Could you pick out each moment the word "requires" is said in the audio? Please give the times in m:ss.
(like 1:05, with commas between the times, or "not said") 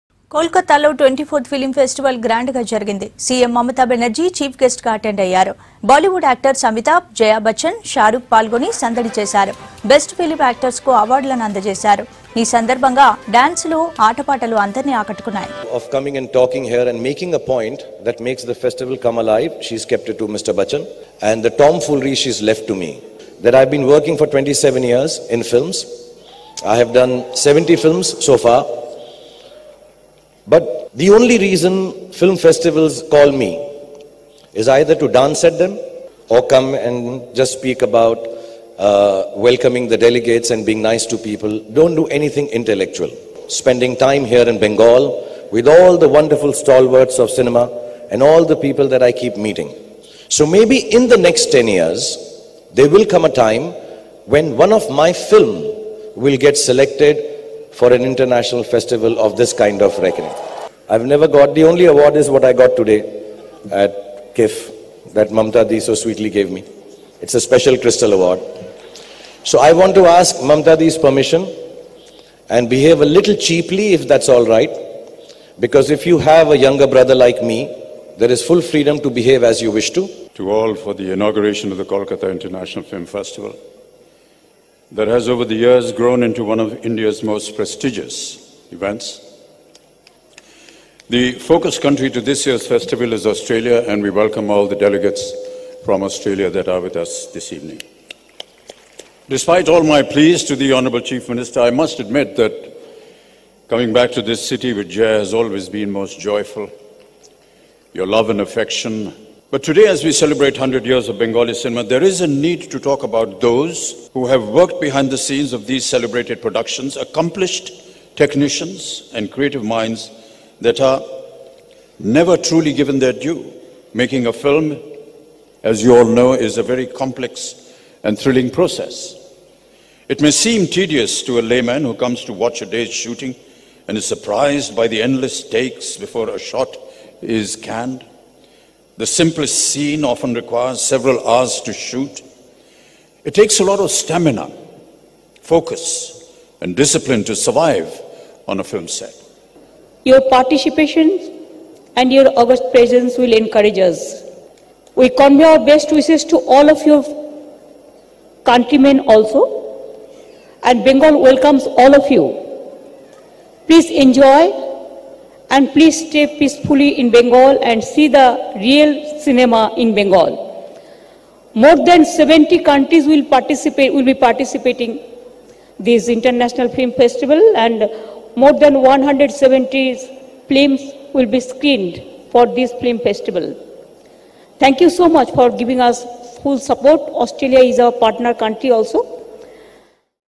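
2:20.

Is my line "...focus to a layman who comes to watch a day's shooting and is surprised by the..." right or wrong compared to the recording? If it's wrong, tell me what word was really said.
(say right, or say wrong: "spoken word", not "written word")
wrong: "tedious", not "focus".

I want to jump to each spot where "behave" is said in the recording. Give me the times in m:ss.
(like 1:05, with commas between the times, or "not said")
1:12, 1:19.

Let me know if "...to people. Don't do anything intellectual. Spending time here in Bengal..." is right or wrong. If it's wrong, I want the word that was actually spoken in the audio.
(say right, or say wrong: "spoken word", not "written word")
right.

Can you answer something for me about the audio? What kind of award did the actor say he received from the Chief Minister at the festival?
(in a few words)
Crystal award.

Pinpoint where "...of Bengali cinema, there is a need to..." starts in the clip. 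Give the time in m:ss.
1:51.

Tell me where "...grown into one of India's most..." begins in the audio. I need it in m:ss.
1:25.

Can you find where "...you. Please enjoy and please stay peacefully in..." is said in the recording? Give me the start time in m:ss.
2:42.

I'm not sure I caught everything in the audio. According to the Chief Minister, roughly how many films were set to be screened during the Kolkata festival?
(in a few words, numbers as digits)
More than 170.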